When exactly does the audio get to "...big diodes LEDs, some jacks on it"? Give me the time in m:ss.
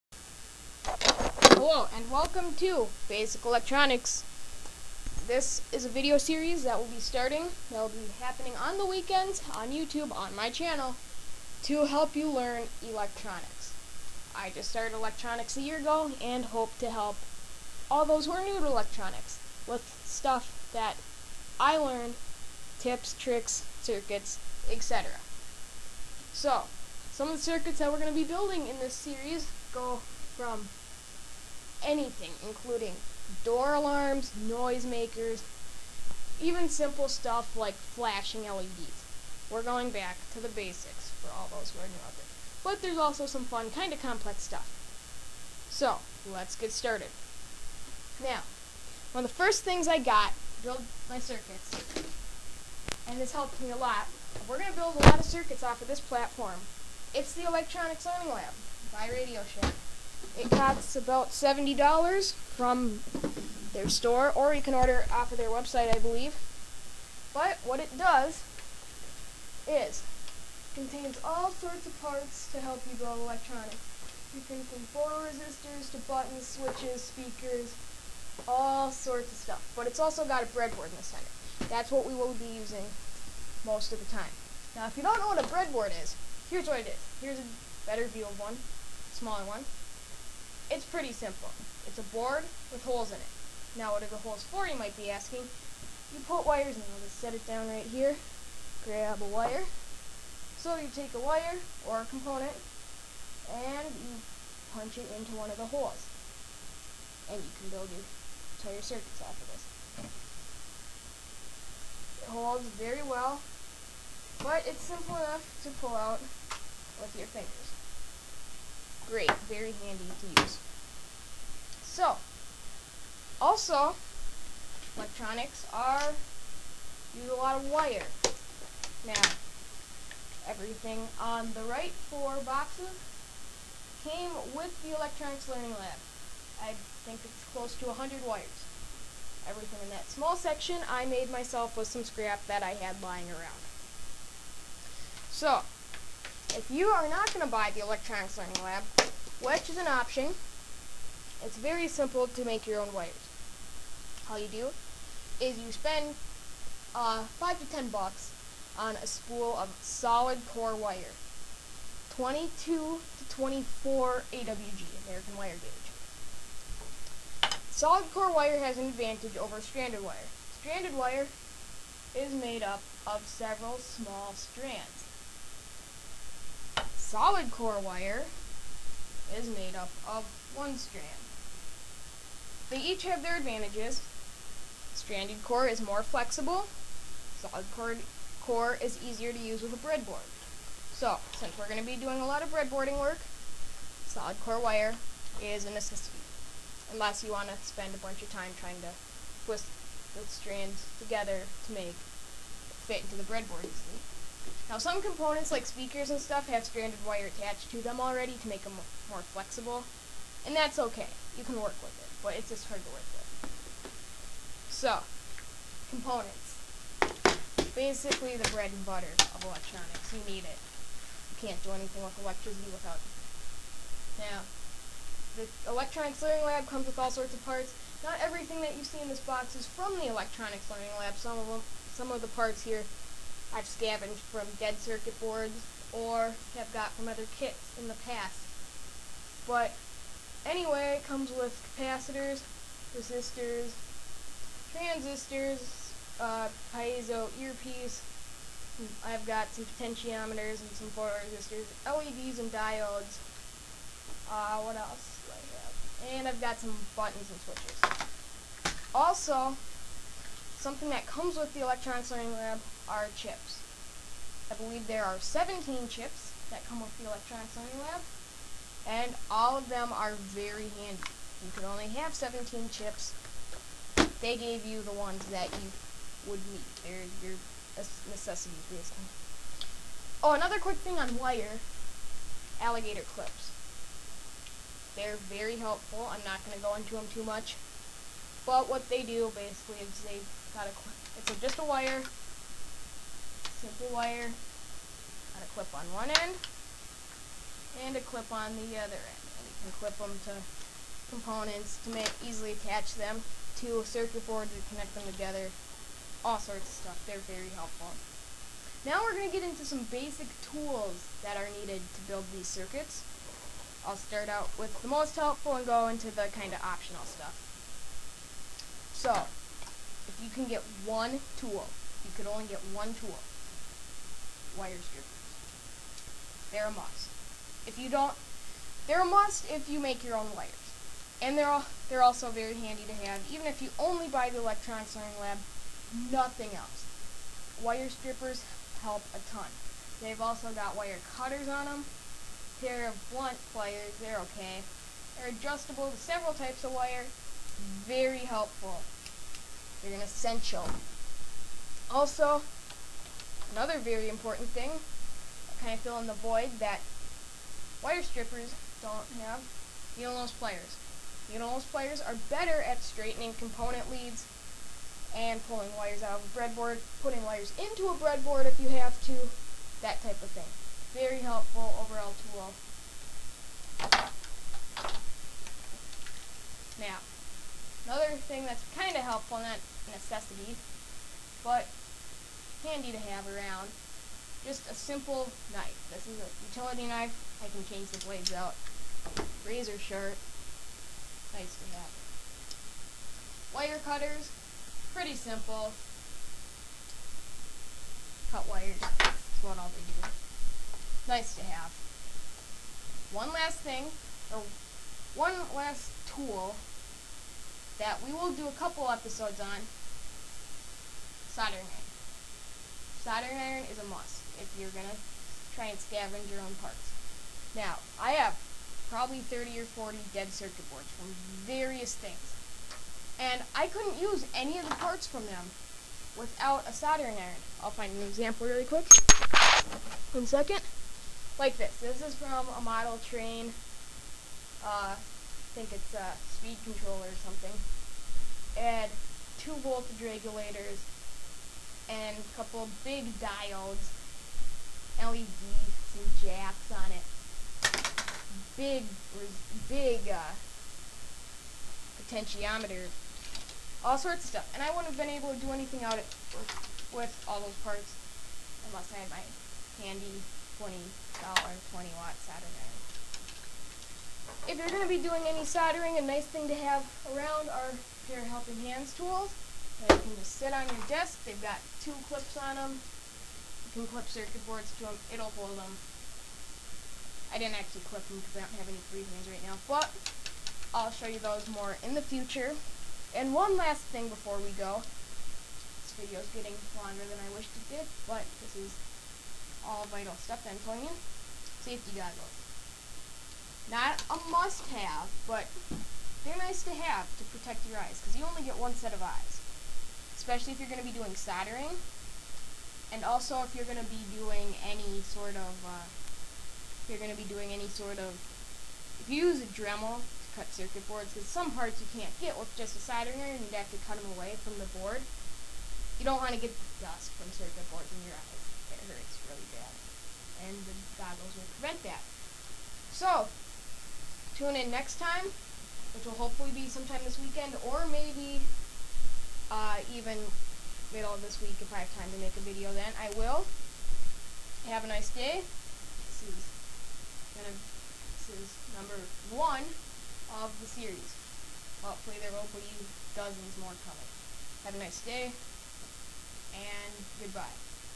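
7:22.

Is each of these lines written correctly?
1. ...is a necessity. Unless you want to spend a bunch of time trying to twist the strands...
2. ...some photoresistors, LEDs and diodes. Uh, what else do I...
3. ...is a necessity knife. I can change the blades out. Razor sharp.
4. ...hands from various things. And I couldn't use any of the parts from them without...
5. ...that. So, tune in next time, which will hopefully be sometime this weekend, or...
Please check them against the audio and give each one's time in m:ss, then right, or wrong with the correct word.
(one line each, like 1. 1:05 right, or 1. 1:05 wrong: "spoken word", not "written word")
1. 3:15 right
2. 4:10 right
3. 6:26 wrong: "utility", not "necessity"
4. 7:00 wrong: "boards", not "hands"
5. 8:41 right.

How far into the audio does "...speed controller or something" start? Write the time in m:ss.
7:16.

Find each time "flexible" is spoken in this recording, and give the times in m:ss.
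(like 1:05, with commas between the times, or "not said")
3:06, 3:29.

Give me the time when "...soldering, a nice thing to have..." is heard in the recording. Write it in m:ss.
7:45.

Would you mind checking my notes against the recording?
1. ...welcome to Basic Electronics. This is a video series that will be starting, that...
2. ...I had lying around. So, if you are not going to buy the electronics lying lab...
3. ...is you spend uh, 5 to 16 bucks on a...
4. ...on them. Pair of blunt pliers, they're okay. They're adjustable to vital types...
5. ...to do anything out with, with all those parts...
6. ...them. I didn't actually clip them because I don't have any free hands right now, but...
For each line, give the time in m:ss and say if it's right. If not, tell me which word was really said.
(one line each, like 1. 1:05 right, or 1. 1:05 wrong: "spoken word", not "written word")
1. 0:02 right
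2. 2:22 wrong: "learning", not "lying"
3. 2:35 wrong: "10", not "16"
4. 5:41 wrong: "several", not "vital"
5. 7:35 right
6. 7:55 right.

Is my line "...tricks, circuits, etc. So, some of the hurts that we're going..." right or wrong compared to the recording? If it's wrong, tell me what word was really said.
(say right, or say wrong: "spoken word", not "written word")
wrong: "circuits", not "hurts".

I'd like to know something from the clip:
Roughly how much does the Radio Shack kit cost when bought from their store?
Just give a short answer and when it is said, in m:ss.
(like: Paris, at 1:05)
$70, at 1:01.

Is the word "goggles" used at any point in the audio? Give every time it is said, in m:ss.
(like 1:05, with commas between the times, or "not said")
8:11, 8:40.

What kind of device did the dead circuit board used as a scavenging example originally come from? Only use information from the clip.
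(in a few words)
A model train.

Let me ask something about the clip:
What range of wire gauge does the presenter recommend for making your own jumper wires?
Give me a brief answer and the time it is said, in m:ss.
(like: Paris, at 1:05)
22 to 24 AWG, at 2:42.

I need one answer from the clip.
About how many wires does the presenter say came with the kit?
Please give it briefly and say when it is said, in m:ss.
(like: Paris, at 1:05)
100, at 2:17.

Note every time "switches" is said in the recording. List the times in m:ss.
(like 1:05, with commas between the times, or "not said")
1:16, 4:17.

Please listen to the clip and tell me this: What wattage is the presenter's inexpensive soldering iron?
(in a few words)
20 watt.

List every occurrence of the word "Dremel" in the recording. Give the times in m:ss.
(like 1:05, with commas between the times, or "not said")
8:29.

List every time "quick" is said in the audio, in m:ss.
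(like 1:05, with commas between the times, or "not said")
4:40, 7:08.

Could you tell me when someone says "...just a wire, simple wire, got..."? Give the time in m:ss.
4:51.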